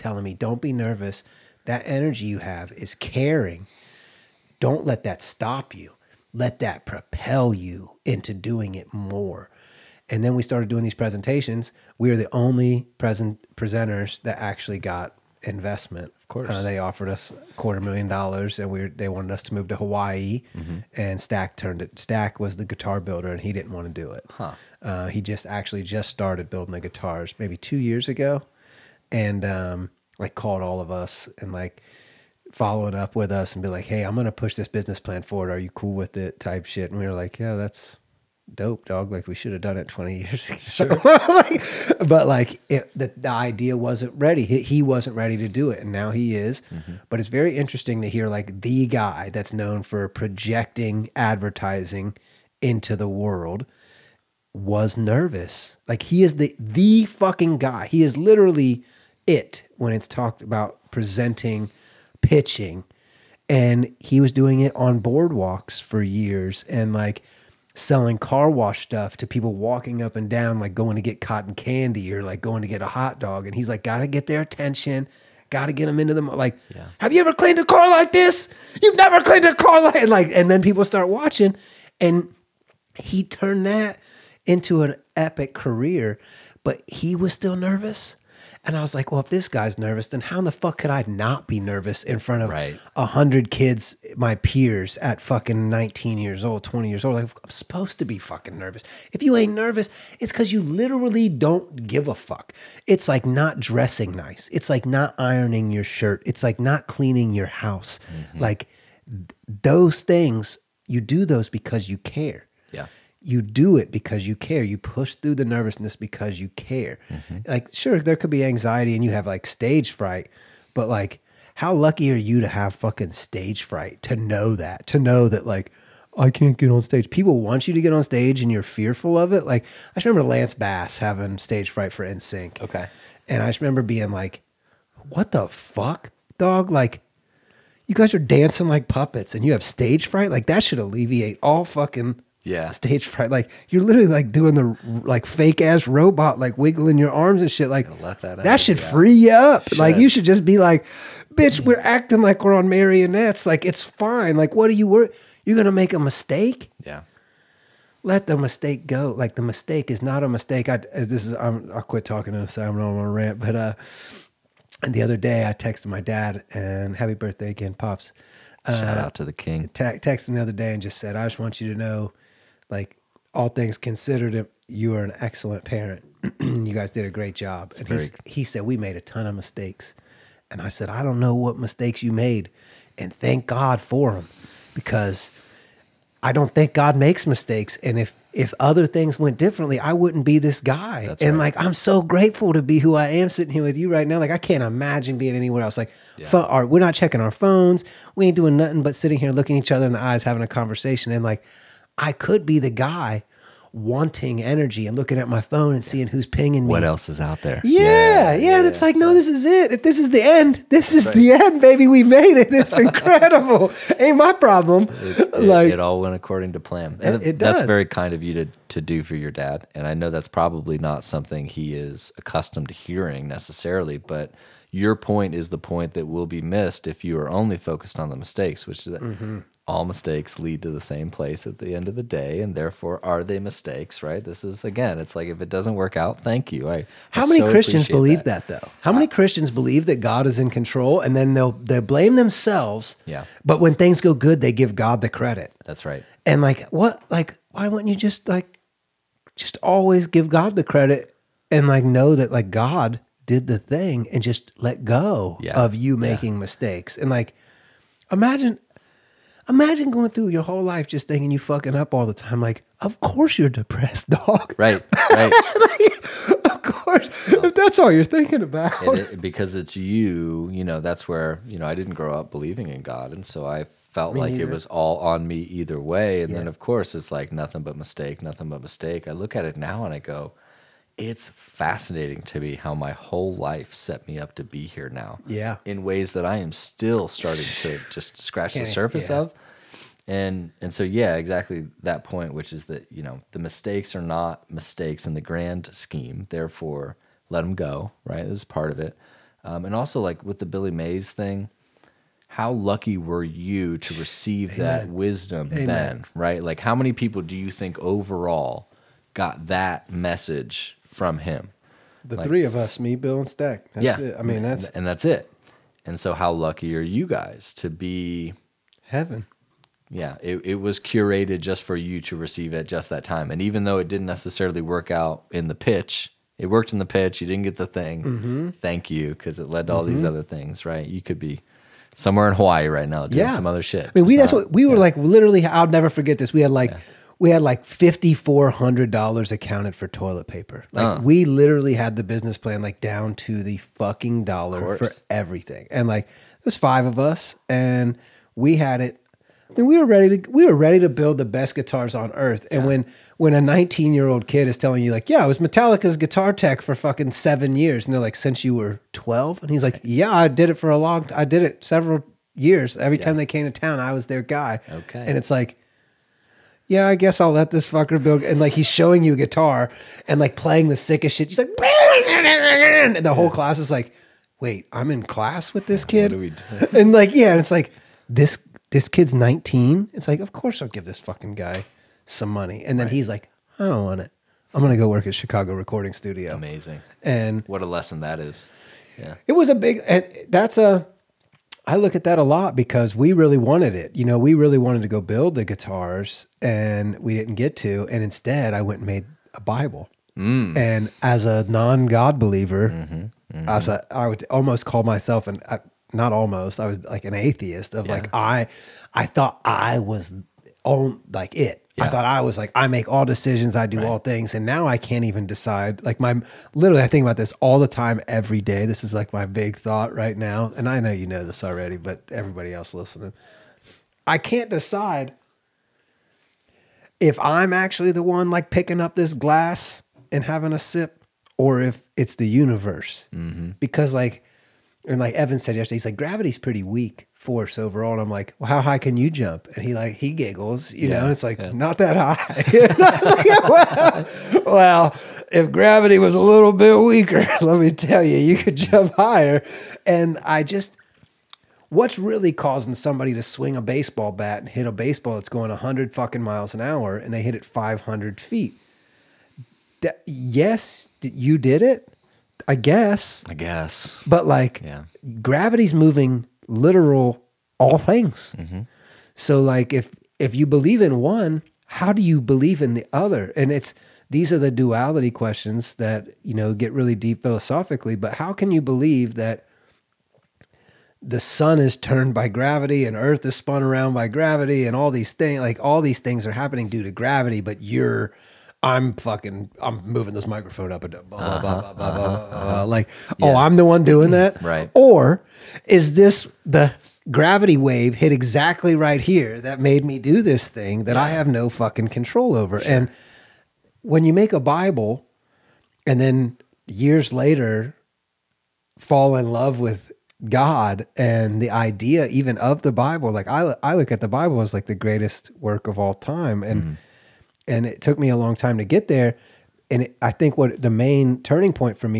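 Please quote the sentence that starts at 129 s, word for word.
Like I just remember Lance Bass having stage fright for NSYNC.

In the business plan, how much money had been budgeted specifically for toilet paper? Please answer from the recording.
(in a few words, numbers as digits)
$5400.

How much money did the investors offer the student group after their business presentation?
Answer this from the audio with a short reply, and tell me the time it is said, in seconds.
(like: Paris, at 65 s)
a quarter million dollars, at 17 s.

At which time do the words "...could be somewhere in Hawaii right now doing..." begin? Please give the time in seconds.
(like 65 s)
331 s.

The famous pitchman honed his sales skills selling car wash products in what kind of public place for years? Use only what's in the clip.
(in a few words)
boardwalks.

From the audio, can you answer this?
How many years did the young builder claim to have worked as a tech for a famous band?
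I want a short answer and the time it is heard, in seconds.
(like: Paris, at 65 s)
7, at 357 s.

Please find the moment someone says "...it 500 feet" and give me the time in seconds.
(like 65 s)
457 s.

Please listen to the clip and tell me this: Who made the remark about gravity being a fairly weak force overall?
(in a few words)
Evan.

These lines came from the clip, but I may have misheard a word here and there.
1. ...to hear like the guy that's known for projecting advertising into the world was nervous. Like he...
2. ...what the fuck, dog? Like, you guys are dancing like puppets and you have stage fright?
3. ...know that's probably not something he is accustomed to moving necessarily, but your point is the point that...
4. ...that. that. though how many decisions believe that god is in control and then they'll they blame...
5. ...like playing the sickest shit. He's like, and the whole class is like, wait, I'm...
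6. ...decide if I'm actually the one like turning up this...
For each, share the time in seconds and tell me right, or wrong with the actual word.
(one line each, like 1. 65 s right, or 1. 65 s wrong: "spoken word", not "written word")
1. 48 s right
2. 135 s right
3. 219 s wrong: "hearing", not "moving"
4. 238 s wrong: "christians", not "decisions"
5. 370 s right
6. 424 s wrong: "picking", not "turning".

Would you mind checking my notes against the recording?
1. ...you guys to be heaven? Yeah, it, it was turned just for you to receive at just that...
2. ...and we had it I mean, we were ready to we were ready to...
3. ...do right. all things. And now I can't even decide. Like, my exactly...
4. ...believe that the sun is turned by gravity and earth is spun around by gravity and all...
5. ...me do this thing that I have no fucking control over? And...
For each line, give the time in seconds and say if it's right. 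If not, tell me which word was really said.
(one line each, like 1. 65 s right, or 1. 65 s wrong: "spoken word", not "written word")
1. 316 s wrong: "curated", not "turned"
2. 347 s right
3. 413 s wrong: "literally", not "exactly"
4. 478 s right
5. 499 s right.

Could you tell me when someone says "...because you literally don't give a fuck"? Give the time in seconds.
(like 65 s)
100 s.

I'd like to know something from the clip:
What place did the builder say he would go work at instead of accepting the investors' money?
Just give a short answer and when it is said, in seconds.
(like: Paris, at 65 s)
Chicago Recording Studio, at 385 s.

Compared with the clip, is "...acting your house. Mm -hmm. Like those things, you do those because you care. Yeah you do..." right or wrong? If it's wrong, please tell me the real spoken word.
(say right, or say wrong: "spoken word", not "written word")
wrong: "cleaning", not "acting".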